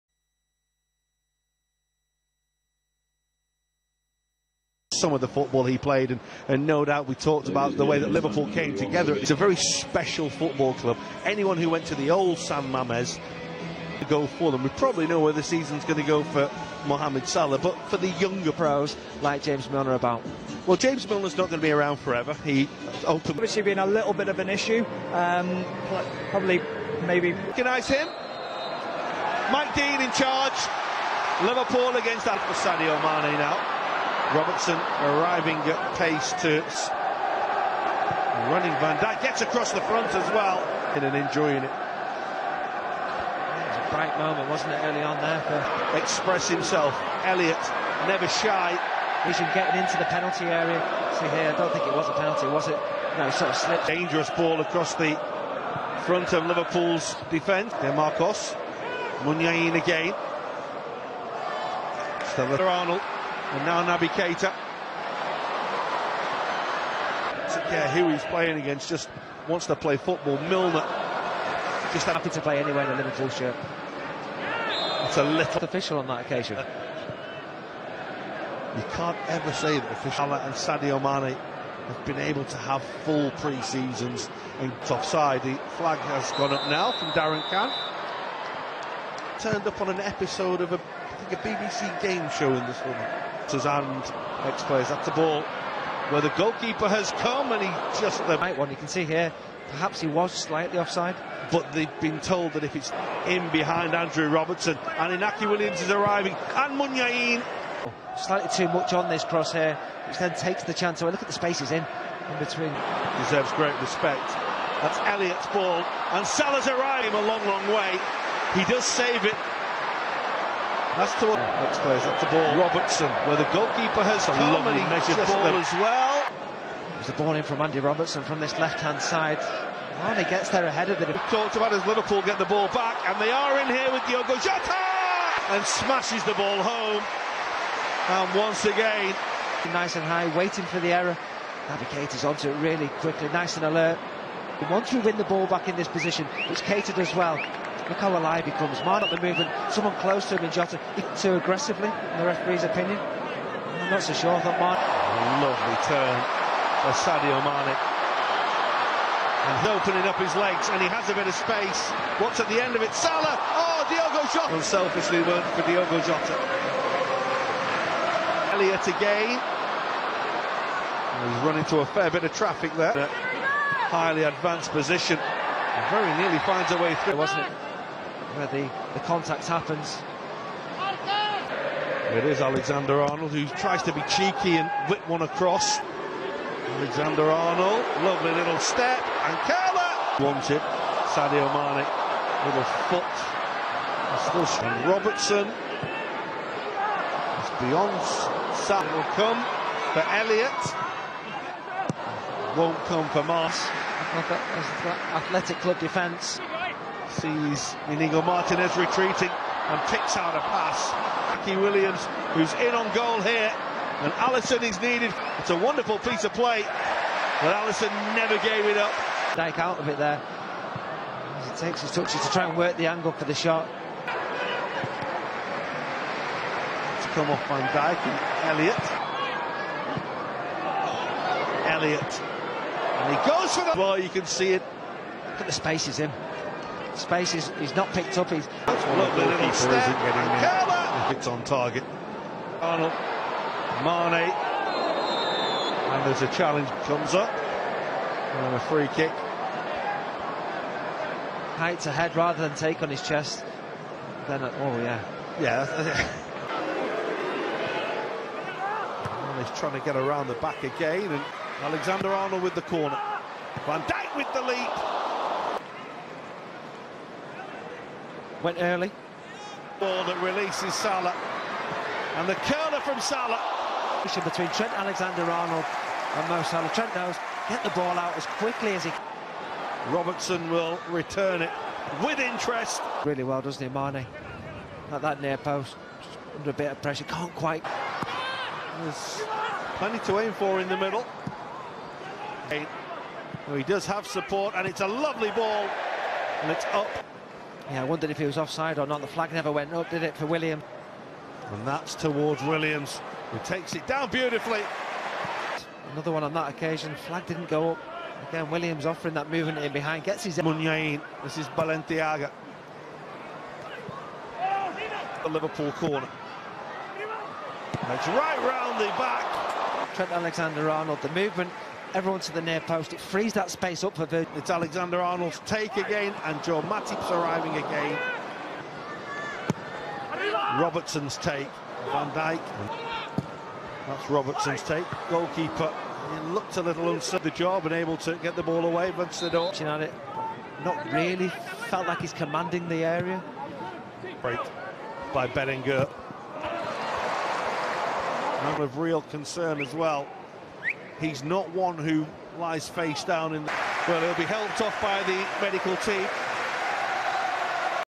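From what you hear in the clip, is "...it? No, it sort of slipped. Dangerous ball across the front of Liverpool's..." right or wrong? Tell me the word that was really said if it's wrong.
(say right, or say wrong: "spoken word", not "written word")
right.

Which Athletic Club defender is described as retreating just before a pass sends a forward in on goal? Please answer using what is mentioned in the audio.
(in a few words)
Inigo Martinez.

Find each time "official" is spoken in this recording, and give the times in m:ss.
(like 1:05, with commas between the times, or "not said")
1:15, 1:19.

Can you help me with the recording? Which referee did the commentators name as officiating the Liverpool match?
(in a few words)
Mike Dean.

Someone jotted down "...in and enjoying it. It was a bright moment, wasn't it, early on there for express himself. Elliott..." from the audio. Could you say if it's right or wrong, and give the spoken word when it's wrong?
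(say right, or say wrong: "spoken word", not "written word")
right.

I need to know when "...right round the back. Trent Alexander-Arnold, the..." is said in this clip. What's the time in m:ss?
5:18.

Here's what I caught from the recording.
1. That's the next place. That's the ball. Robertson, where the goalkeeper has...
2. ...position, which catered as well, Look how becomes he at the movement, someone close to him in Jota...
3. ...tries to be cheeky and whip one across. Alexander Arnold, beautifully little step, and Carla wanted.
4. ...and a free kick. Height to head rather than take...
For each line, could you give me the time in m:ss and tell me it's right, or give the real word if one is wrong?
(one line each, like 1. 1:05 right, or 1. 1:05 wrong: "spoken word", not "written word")
1. 2:00 right
2. 2:25 right
3. 3:03 wrong: "lovely", not "beautifully"
4. 4:07 right.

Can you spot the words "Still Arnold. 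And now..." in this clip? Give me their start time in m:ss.
1:02.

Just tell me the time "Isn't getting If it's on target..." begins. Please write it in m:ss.
3:59.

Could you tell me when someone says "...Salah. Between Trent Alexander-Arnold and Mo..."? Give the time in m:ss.
4:32.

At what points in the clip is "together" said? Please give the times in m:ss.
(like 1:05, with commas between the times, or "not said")
0:08.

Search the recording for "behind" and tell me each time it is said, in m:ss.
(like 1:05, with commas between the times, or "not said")
1:43, 5:09.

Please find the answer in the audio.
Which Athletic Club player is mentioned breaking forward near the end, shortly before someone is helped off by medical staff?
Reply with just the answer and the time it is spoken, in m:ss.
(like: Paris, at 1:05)
Berenguer, at 5:45.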